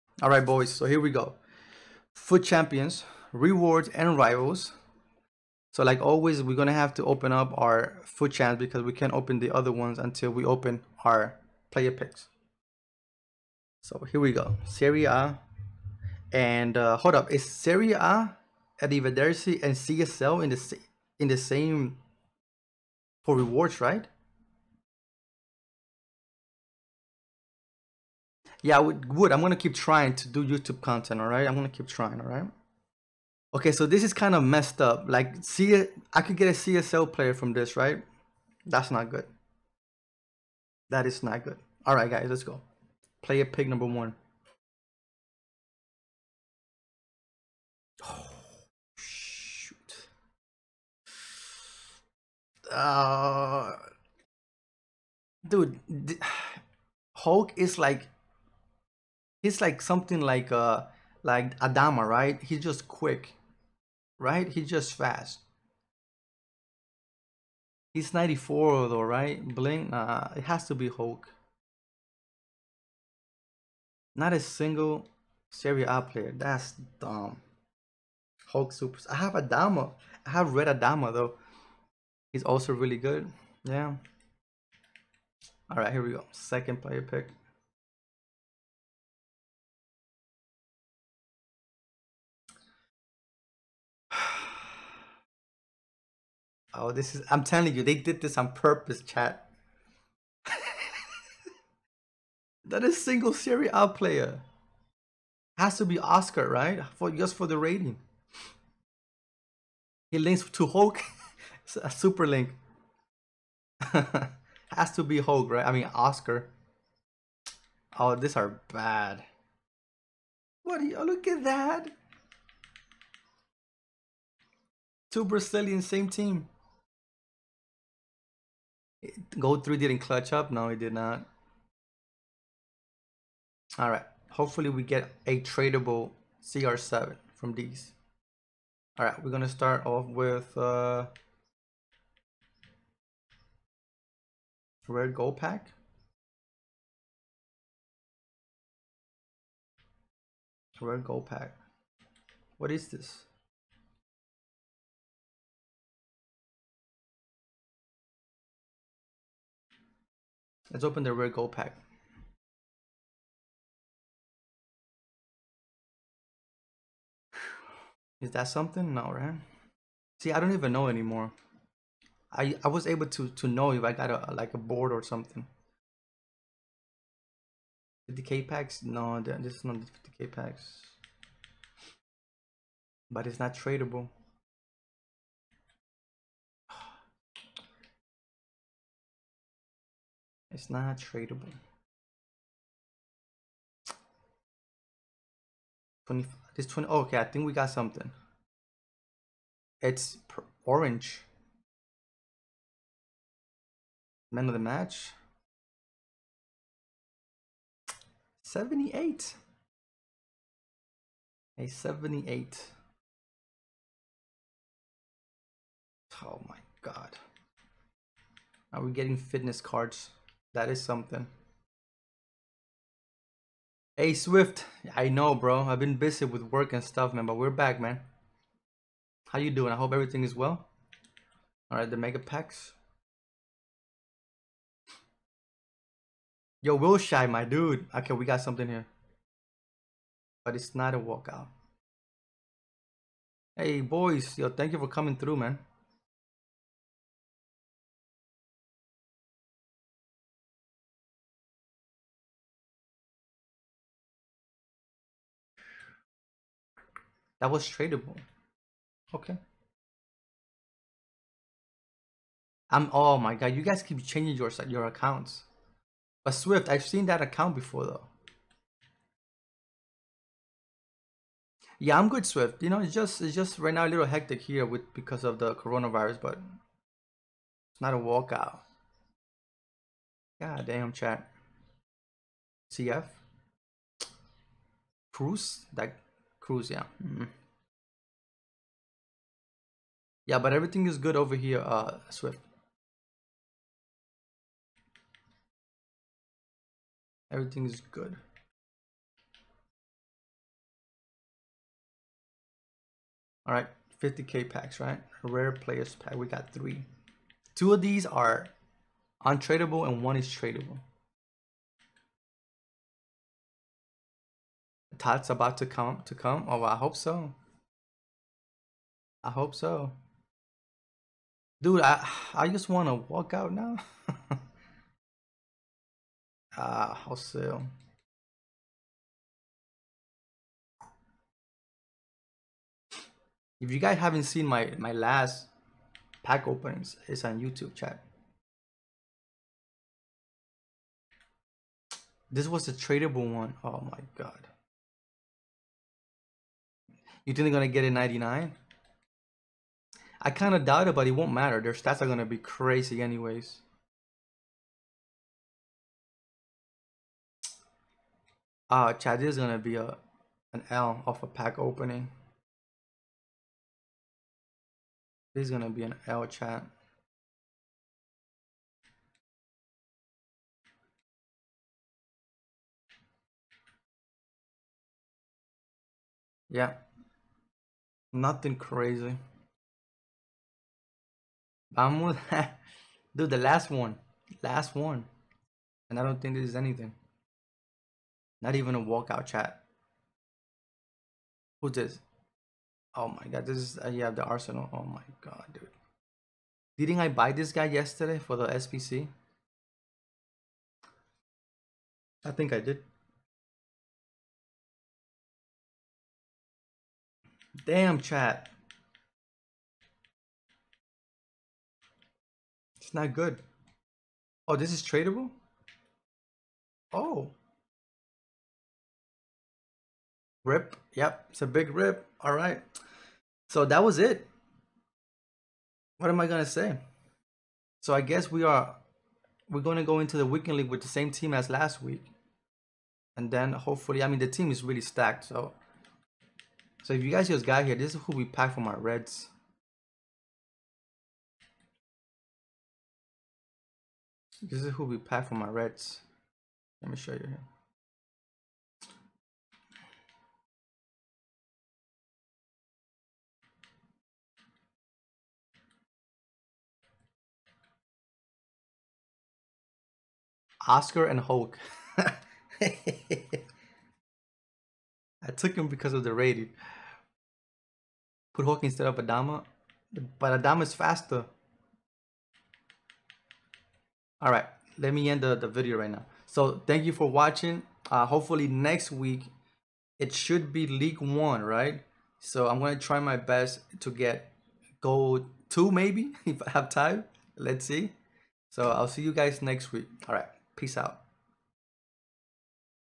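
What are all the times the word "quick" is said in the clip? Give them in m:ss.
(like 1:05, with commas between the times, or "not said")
1:02.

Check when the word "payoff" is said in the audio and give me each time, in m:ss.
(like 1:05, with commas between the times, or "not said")
not said.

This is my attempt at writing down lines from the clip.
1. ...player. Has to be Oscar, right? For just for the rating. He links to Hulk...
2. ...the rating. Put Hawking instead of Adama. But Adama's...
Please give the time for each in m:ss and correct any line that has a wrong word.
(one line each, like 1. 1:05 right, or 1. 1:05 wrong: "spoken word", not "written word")
1. 1:43 right
2. 7:46 right.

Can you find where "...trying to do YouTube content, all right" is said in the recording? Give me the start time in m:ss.
0:29.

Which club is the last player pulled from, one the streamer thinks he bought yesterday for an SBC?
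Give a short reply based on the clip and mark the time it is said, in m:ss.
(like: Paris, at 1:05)
Arsenal, at 6:34.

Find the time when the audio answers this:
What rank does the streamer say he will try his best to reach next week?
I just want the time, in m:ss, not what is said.
8:04.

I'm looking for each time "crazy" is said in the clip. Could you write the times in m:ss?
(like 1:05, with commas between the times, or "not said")
5:52, 6:18.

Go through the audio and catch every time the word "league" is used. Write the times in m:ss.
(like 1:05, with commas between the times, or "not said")
7:10, 8:00.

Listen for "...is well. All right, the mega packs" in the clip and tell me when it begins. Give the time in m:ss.
3:50.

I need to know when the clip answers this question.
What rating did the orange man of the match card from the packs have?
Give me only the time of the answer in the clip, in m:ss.
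3:31.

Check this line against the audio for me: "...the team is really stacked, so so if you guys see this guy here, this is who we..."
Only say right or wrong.
right.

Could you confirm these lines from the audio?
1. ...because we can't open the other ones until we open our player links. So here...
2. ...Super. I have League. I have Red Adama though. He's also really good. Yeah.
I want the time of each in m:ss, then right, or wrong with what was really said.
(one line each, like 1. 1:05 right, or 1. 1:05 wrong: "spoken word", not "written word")
1. 0:08 wrong: "picks", not "links"
2. 1:18 wrong: "Adama", not "League".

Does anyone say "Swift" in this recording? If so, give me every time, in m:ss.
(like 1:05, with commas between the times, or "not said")
3:44, 4:26, 4:32, 4:52.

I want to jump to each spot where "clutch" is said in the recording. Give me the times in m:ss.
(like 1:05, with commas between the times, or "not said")
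2:09.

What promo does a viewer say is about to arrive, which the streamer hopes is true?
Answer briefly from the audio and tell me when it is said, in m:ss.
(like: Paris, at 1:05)
TOTS, at 5:14.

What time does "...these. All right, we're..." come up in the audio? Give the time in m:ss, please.
2:17.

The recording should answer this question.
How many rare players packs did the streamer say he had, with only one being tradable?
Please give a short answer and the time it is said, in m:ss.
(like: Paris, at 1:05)
three, at 5:06.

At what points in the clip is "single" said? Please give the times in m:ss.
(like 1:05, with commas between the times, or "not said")
1:14, 1:43.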